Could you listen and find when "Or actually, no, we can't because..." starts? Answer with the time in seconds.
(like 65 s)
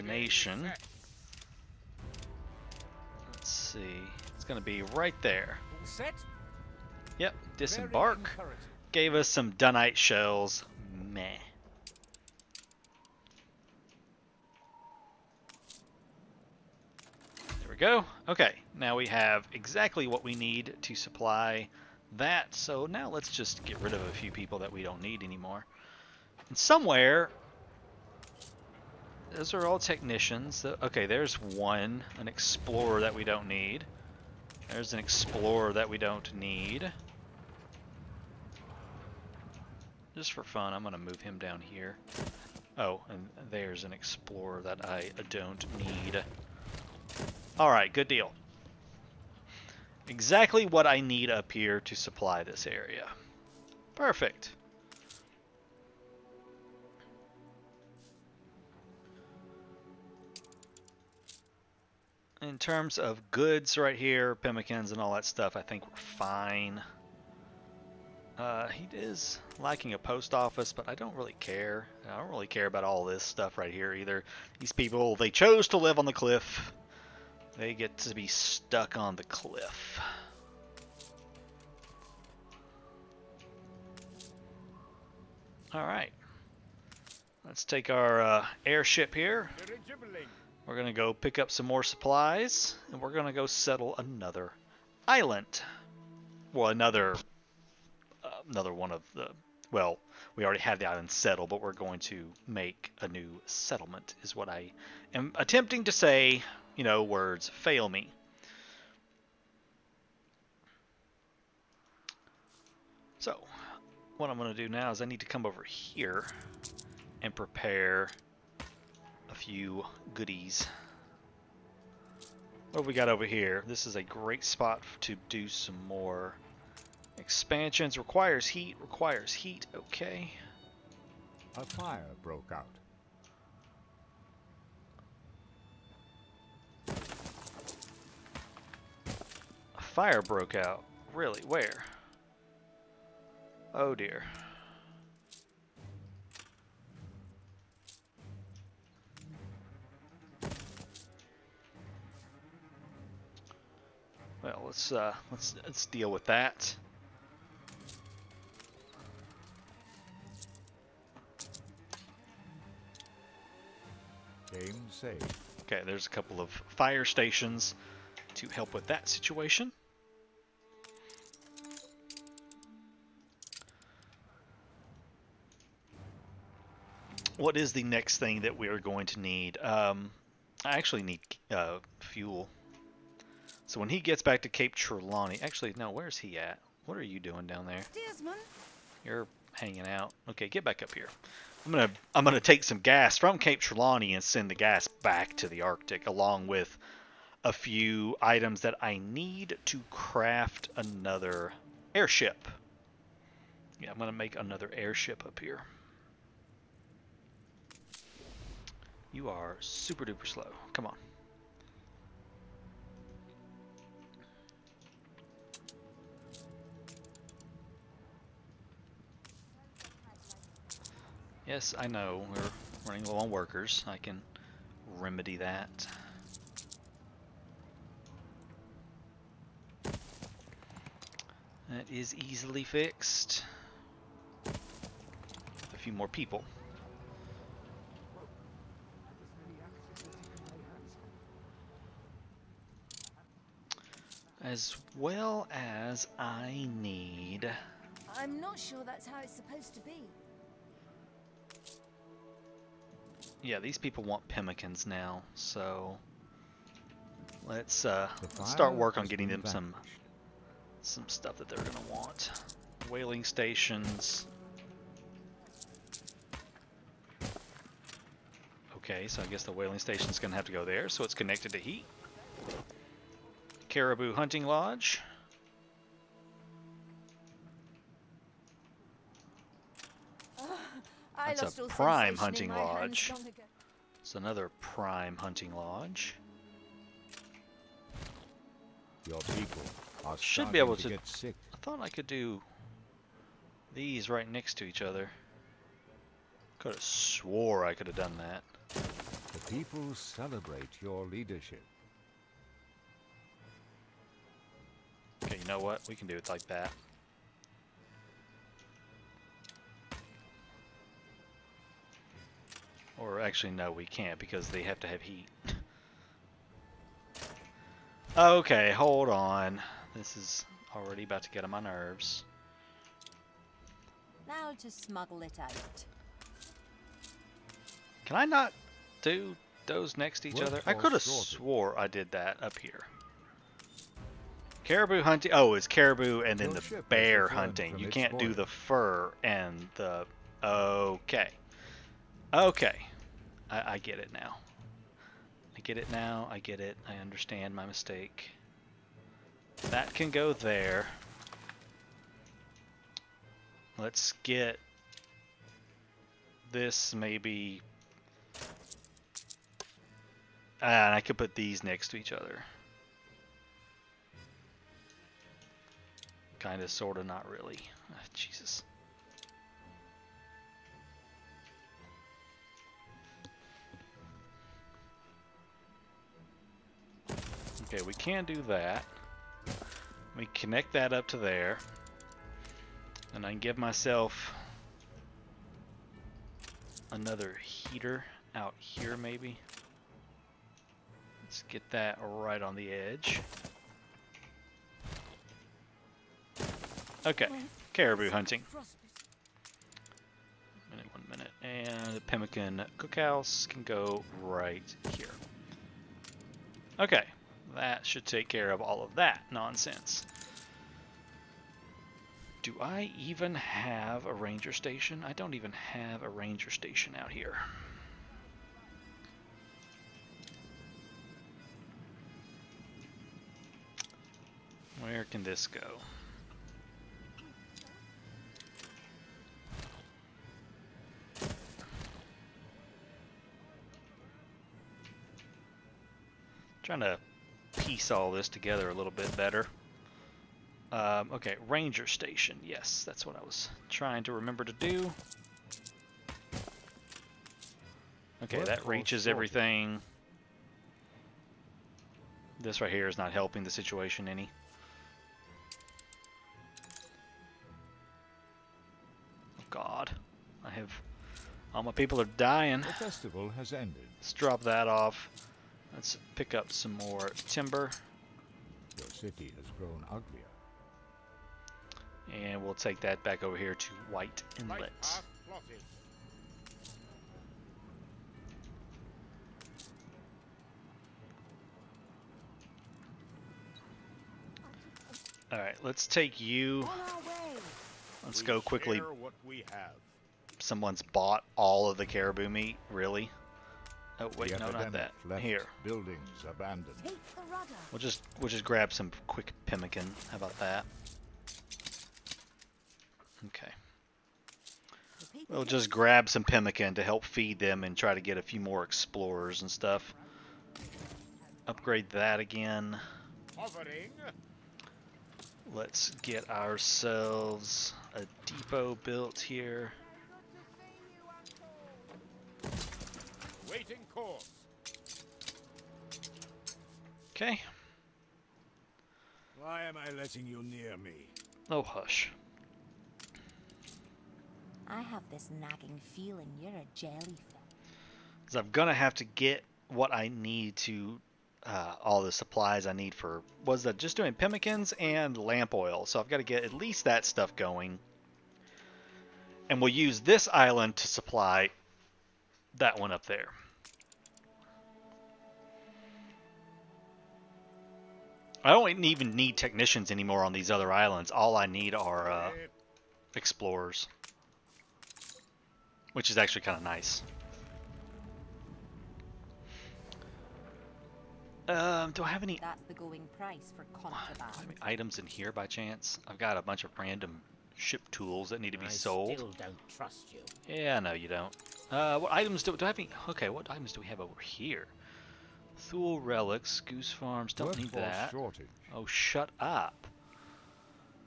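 312 s.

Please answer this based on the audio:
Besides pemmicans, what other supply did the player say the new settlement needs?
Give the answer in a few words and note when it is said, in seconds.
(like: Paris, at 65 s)
Lamp oil, at 545 s.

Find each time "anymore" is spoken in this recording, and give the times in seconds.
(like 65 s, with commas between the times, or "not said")
25 s, 559 s.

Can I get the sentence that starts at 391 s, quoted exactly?
Let's get that right on the edge.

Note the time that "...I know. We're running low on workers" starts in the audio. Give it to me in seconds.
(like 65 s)
221 s.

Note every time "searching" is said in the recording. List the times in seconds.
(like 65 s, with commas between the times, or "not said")
not said.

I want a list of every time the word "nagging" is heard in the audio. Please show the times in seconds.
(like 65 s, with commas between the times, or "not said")
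535 s.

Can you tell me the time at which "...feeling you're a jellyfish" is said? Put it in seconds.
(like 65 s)
535 s.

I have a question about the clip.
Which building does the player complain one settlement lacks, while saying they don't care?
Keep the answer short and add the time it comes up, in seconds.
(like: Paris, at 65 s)
Post office, at 69 s.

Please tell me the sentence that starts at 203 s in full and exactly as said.
Yeah, I'm gonna make another airship up here.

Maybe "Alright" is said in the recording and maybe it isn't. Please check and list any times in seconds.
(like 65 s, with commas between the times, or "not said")
47 s, 85 s, 485 s.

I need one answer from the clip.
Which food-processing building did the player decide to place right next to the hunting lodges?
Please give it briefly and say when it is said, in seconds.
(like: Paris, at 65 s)
Pemmican cookhouse, at 402 s.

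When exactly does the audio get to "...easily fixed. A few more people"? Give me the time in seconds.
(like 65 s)
232 s.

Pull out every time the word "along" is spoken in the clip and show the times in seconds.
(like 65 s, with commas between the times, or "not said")
196 s.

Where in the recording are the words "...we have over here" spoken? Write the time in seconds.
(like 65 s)
583 s.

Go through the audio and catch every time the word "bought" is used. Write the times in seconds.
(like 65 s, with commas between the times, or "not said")
490 s.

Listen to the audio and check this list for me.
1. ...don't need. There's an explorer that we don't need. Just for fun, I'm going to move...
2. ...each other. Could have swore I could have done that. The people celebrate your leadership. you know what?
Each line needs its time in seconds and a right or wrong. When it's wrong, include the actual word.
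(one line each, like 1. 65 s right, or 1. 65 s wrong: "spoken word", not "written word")
1. 33 s right
2. 294 s right.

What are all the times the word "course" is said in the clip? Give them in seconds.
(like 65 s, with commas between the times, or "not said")
523 s.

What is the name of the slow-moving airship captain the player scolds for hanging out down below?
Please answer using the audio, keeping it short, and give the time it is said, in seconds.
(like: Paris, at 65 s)
Desmond, at 188 s.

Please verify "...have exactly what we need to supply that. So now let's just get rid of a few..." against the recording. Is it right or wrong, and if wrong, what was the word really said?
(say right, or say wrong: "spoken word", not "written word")
right.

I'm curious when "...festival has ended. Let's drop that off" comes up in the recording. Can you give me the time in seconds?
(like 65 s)
462 s.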